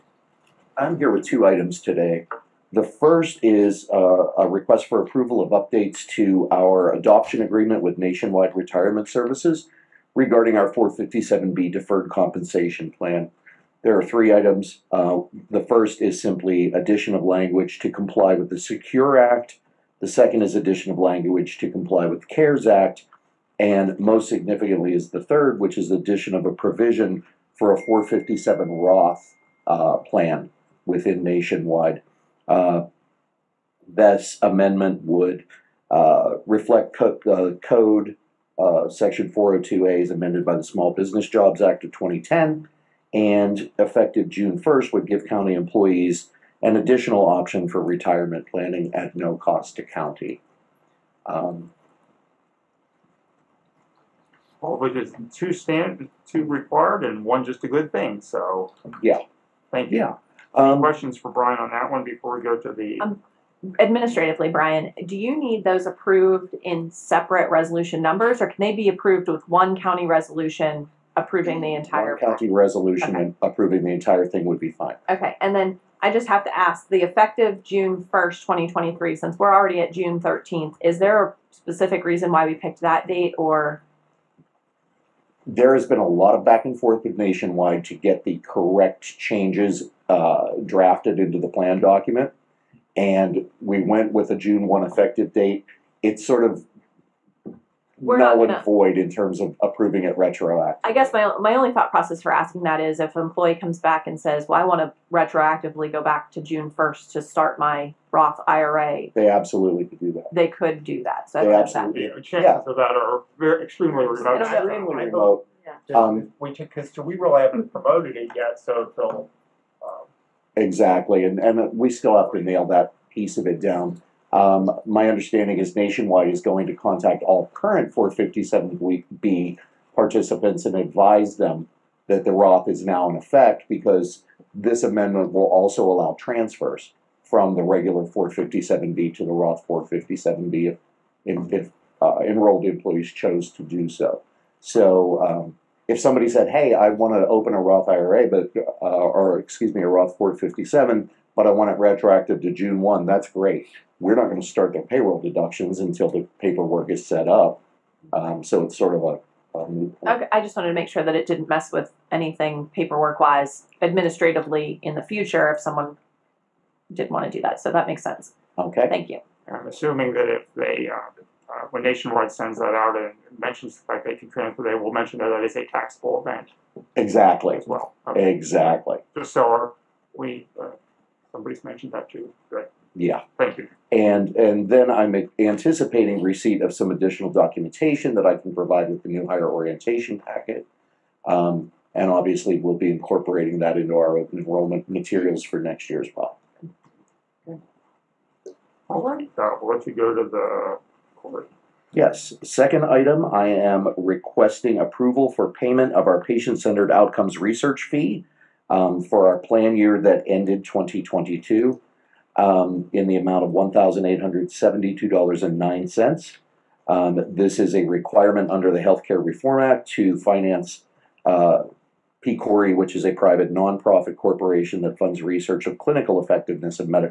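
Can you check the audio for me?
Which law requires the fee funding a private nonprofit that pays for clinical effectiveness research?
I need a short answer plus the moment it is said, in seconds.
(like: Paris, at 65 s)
Healthcare Reform Act, at 218 s.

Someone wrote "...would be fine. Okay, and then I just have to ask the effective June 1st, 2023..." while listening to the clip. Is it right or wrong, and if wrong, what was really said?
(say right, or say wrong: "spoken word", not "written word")
right.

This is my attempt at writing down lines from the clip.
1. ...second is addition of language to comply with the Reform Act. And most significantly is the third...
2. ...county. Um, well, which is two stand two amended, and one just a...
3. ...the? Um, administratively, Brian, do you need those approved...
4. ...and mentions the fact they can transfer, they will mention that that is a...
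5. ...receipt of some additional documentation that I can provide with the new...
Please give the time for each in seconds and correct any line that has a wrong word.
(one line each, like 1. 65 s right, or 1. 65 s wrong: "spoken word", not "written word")
1. 20 s wrong: "CARES", not "Reform"
2. 49 s wrong: "required", not "amended"
3. 62 s right
4. 172 s right
5. 186 s right.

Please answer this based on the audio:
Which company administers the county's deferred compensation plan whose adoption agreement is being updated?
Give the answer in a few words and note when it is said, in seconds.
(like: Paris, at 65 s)
Nationwide Retirement Services, at 7 s.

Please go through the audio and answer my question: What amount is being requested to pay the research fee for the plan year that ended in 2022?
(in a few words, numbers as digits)
$1,872.09.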